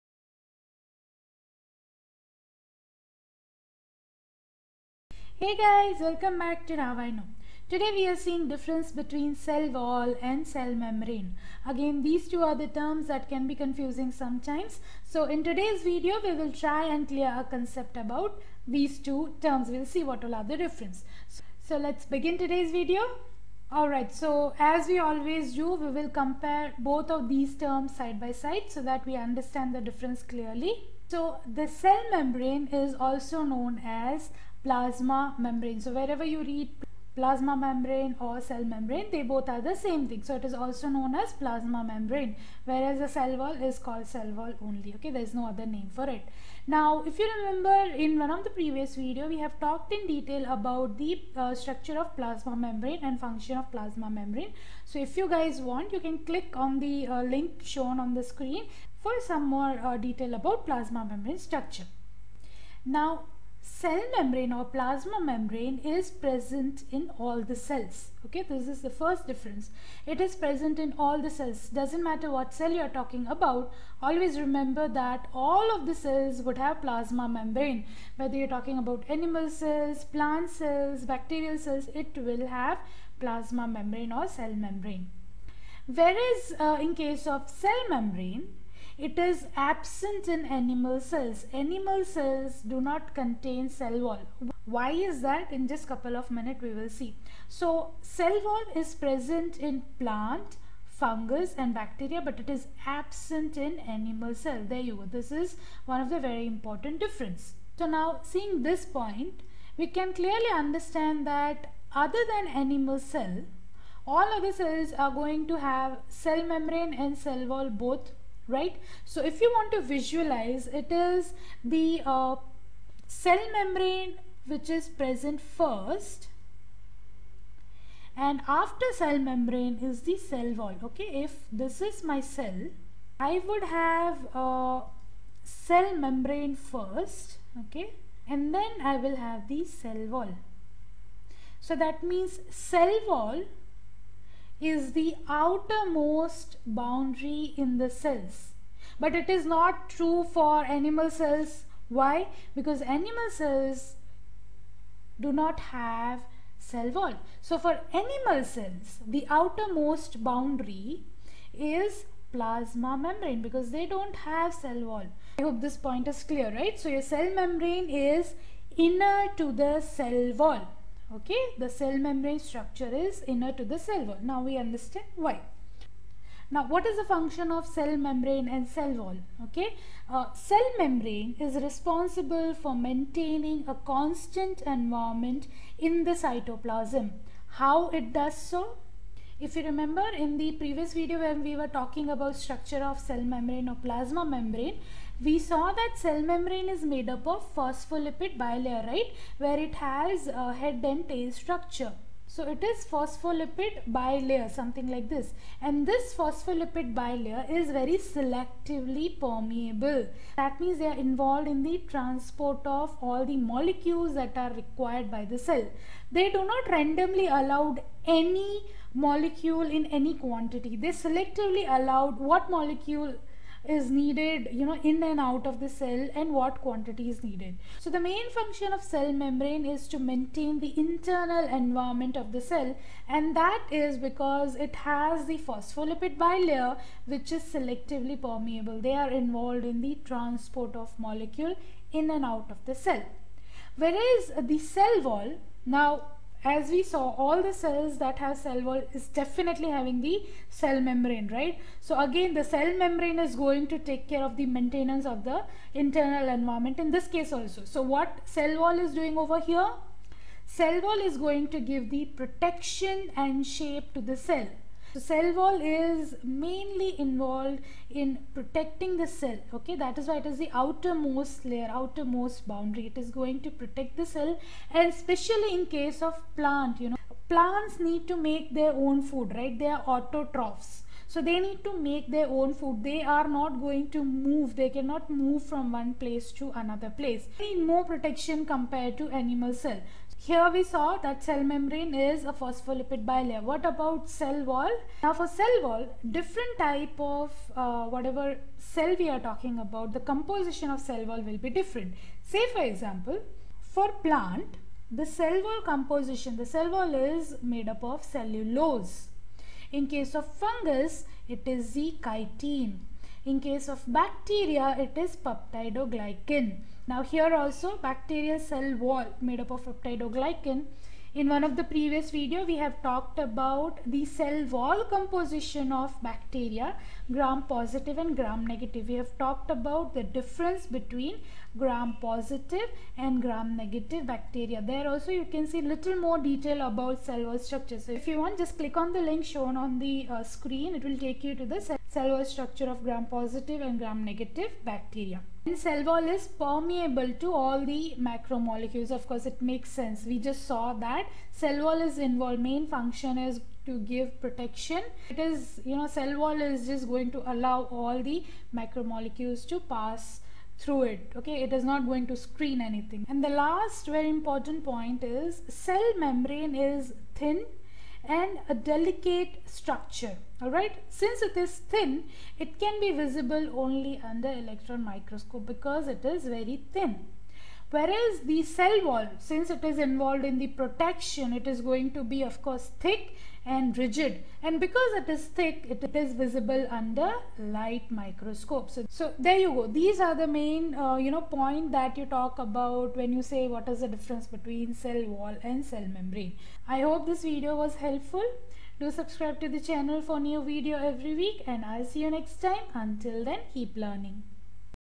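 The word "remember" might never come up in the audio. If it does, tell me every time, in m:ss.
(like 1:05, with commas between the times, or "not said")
0:47, 1:14, 3:09.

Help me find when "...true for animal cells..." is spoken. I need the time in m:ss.
2:29.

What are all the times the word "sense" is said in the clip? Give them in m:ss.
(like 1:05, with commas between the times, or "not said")
5:49.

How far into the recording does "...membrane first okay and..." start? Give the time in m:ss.
2:16.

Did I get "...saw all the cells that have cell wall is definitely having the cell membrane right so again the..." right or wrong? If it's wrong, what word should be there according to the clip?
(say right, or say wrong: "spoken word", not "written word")
right.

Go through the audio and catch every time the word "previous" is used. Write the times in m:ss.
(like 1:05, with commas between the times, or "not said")
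0:48, 3:10, 5:21.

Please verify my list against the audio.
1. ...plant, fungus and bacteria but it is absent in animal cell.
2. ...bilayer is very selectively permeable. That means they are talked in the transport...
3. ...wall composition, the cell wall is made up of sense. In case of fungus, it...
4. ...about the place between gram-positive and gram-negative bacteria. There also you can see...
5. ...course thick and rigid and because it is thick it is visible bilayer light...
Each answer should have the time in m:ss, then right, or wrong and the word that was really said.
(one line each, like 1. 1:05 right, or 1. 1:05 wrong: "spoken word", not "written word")
1. 1:40 right
2. 3:26 wrong: "involved", not "talked"
3. 5:05 wrong: "cellulose", not "sense"
4. 5:29 wrong: "difference", not "place"
5. 6:22 wrong: "under", not "bilayer".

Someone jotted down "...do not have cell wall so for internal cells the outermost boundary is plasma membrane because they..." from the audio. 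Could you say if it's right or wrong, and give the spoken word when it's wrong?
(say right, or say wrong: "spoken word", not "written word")
wrong: "animal", not "internal".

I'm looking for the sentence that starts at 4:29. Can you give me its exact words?
Okay, that is why it is the outermost layer, outermost boundary.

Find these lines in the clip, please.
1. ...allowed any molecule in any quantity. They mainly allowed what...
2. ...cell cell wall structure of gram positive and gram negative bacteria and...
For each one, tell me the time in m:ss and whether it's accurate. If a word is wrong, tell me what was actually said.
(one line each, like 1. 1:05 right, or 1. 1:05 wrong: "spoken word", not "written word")
1. 3:37 wrong: "selectively", not "mainly"
2. 5:41 right.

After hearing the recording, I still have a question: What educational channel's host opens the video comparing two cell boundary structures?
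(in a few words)
Now I Know.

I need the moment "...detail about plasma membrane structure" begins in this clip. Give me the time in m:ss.
0:59.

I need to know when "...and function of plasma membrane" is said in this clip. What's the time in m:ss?
0:53.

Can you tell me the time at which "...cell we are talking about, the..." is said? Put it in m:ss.
4:58.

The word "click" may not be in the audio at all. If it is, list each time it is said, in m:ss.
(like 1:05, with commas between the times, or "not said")
0:56, 5:38.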